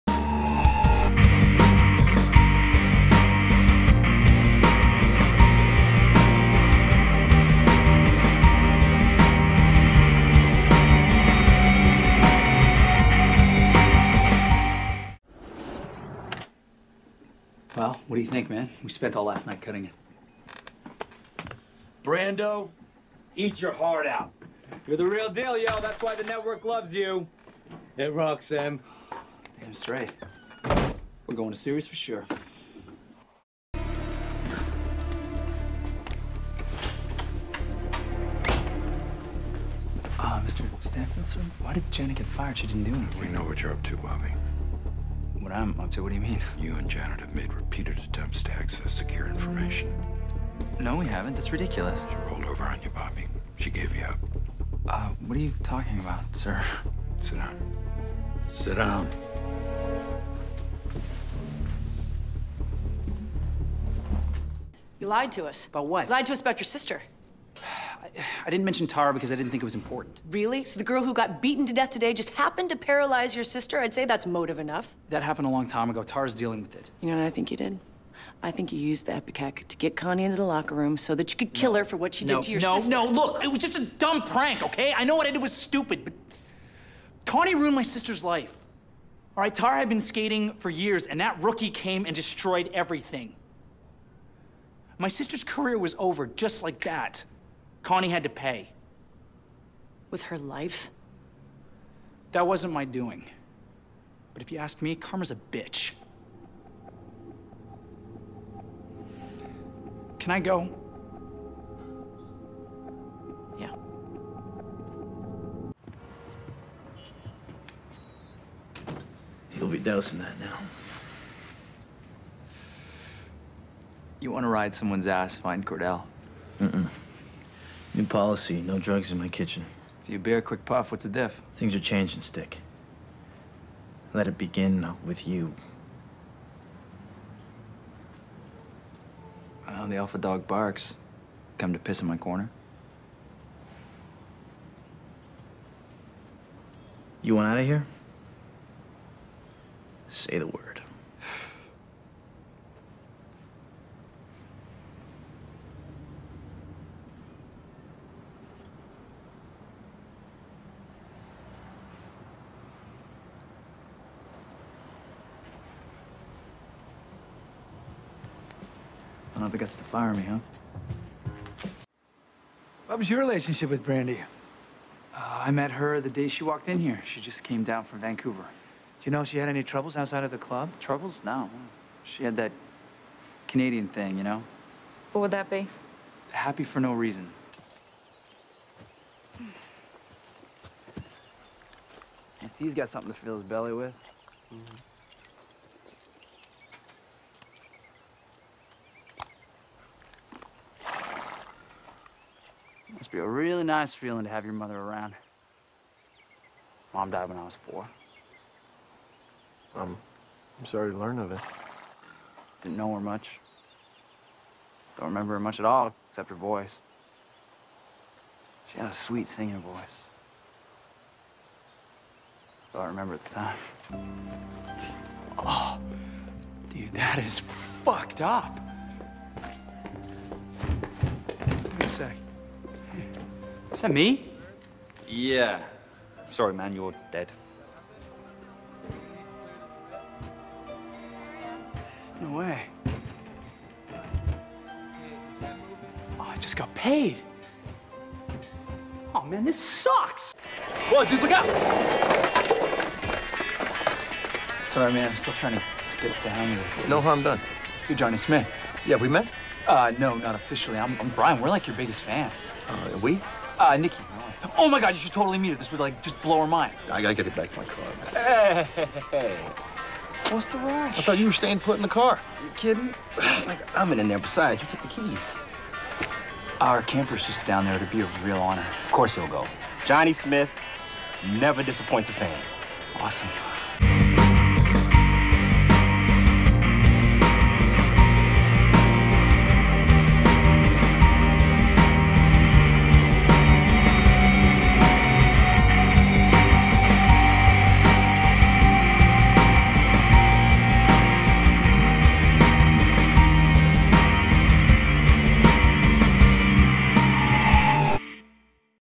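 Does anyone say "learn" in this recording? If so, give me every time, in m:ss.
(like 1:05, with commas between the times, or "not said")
3:30.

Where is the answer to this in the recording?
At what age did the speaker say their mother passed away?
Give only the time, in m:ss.
3:27.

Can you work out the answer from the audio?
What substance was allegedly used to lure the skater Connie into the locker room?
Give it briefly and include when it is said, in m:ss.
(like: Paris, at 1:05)
ipecac, at 1:19.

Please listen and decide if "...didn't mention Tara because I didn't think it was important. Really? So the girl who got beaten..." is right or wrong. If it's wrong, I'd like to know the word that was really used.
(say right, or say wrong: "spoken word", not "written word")
right.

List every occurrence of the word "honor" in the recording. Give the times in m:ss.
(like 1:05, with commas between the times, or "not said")
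4:38.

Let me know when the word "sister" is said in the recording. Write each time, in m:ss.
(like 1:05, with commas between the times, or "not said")
1:06, 1:13, 1:22, 1:27, 1:35.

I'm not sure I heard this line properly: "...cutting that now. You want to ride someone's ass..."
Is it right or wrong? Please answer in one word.
wrong.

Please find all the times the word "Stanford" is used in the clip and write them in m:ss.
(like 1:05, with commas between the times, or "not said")
0:40.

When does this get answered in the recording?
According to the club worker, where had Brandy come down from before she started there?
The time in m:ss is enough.
2:58.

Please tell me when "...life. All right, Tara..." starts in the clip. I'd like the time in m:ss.
1:28.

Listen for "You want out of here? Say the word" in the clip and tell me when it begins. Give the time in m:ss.
2:27.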